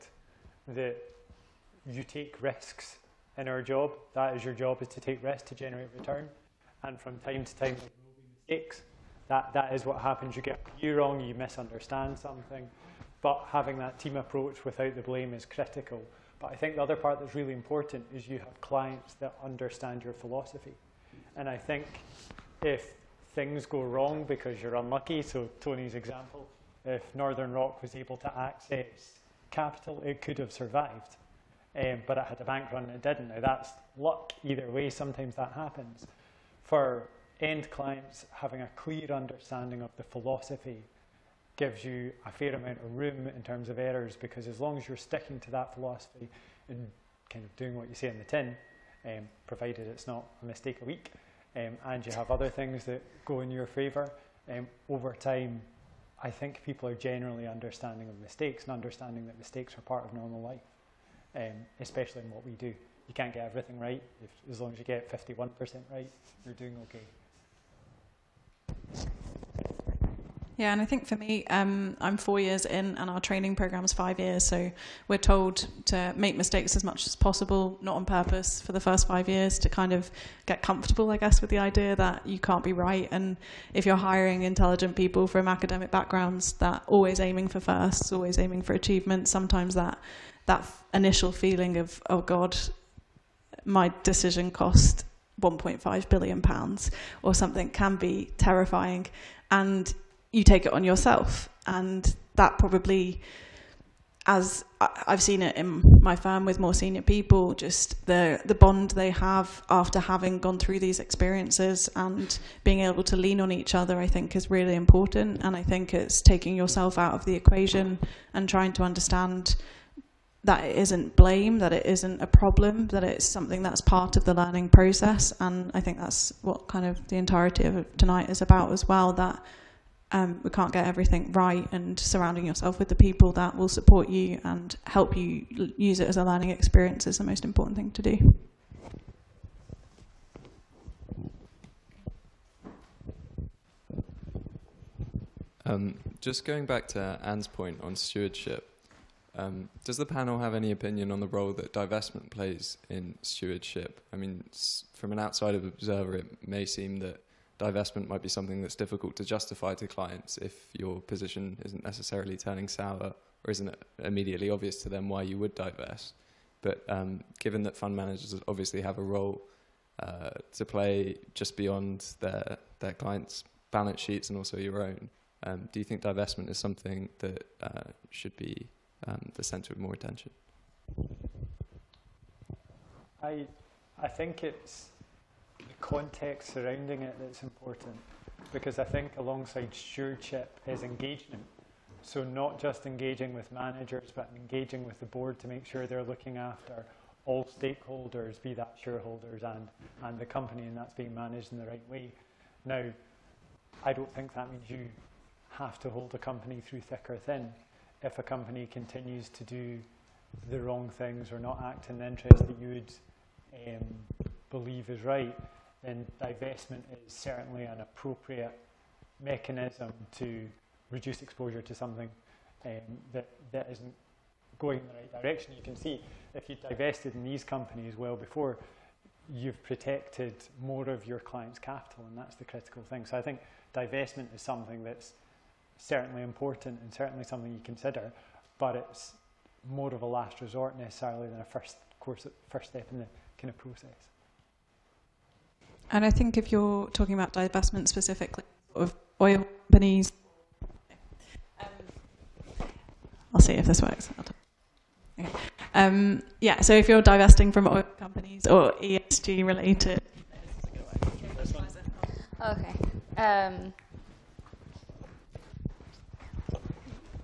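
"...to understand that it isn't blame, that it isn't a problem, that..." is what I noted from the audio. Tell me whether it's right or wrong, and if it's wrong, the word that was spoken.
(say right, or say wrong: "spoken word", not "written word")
right.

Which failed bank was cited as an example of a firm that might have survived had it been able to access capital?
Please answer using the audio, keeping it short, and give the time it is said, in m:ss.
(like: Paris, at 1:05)
Northern Rock, at 0:27.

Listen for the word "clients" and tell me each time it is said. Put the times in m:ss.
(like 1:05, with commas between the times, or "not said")
0:18, 0:37, 2:39, 2:52, 3:51.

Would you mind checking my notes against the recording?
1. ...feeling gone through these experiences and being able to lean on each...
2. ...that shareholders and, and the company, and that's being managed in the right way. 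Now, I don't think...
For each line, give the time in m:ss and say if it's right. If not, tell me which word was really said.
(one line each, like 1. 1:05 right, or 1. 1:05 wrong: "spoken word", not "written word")
1. 1:49 wrong: "having", not "feeling"
2. 3:18 right.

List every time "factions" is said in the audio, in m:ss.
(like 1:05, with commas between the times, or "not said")
not said.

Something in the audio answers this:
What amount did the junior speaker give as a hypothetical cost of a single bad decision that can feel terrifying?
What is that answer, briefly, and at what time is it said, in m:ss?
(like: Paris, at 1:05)
1.5 billion pounds, at 1:35.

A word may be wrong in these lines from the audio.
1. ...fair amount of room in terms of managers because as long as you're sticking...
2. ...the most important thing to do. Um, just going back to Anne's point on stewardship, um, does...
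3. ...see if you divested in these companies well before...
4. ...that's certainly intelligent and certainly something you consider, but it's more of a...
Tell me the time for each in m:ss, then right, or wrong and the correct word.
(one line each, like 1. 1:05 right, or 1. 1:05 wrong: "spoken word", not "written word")
1. 0:42 wrong: "errors", not "managers"
2. 2:17 right
3. 3:45 right
4. 3:54 wrong: "important", not "intelligent".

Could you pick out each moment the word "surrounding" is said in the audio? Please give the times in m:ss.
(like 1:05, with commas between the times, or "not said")
2:11, 3:06.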